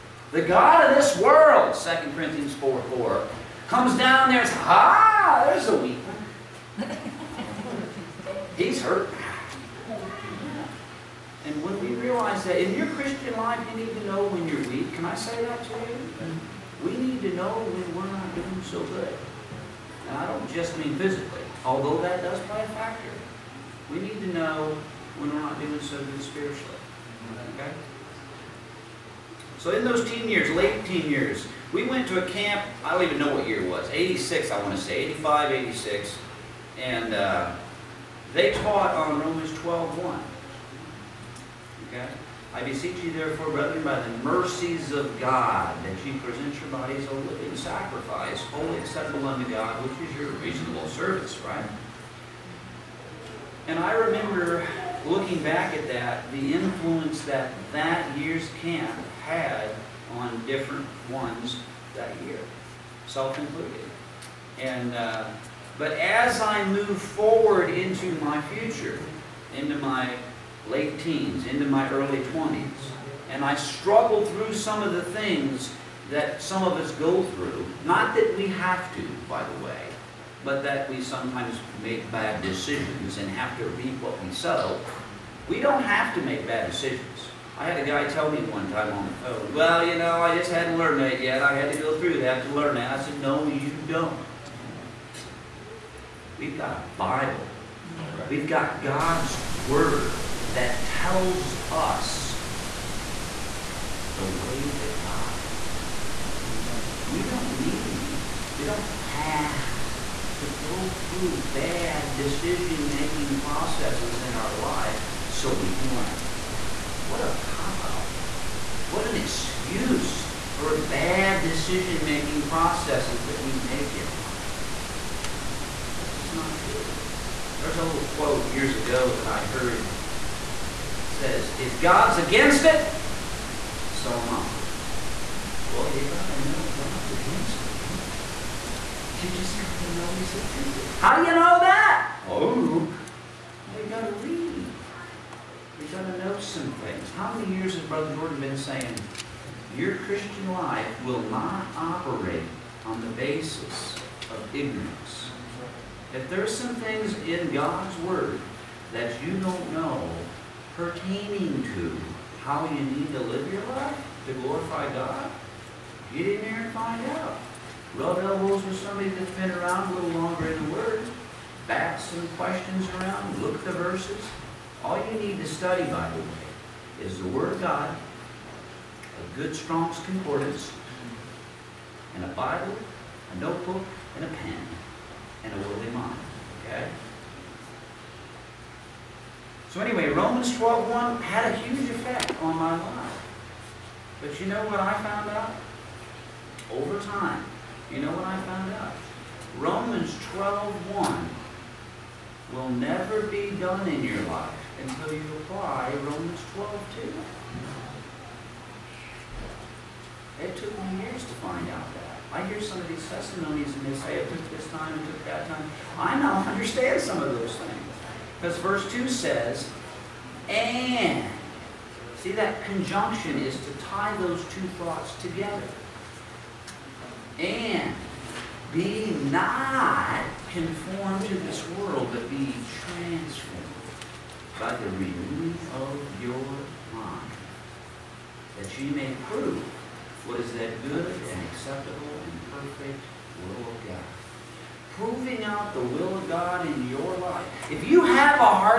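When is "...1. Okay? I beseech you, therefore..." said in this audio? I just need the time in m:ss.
0:40.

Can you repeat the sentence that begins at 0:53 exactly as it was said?
And I remember looking back at that, the influence that that year's camp had on different ones that year, self included.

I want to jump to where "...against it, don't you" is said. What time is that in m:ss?
2:17.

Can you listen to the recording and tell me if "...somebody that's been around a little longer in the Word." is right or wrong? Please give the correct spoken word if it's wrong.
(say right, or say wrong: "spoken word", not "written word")
right.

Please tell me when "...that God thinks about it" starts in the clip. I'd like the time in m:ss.
1:44.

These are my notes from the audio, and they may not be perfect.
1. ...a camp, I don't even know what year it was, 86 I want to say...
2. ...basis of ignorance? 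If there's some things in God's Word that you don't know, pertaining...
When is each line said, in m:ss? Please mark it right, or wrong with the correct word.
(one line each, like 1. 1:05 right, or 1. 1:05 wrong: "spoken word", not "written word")
1. 0:32 right
2. 2:33 right.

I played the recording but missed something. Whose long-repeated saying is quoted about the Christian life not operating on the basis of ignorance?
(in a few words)
Brother Jordan.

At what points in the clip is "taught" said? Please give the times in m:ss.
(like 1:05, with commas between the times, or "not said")
0:38.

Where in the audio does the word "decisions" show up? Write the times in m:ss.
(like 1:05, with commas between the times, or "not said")
1:22, 1:26, 1:52, 2:01.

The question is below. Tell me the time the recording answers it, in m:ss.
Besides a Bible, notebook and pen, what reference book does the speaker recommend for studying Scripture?
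2:59.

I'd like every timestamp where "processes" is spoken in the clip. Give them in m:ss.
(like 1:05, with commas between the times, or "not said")
1:53, 2:02.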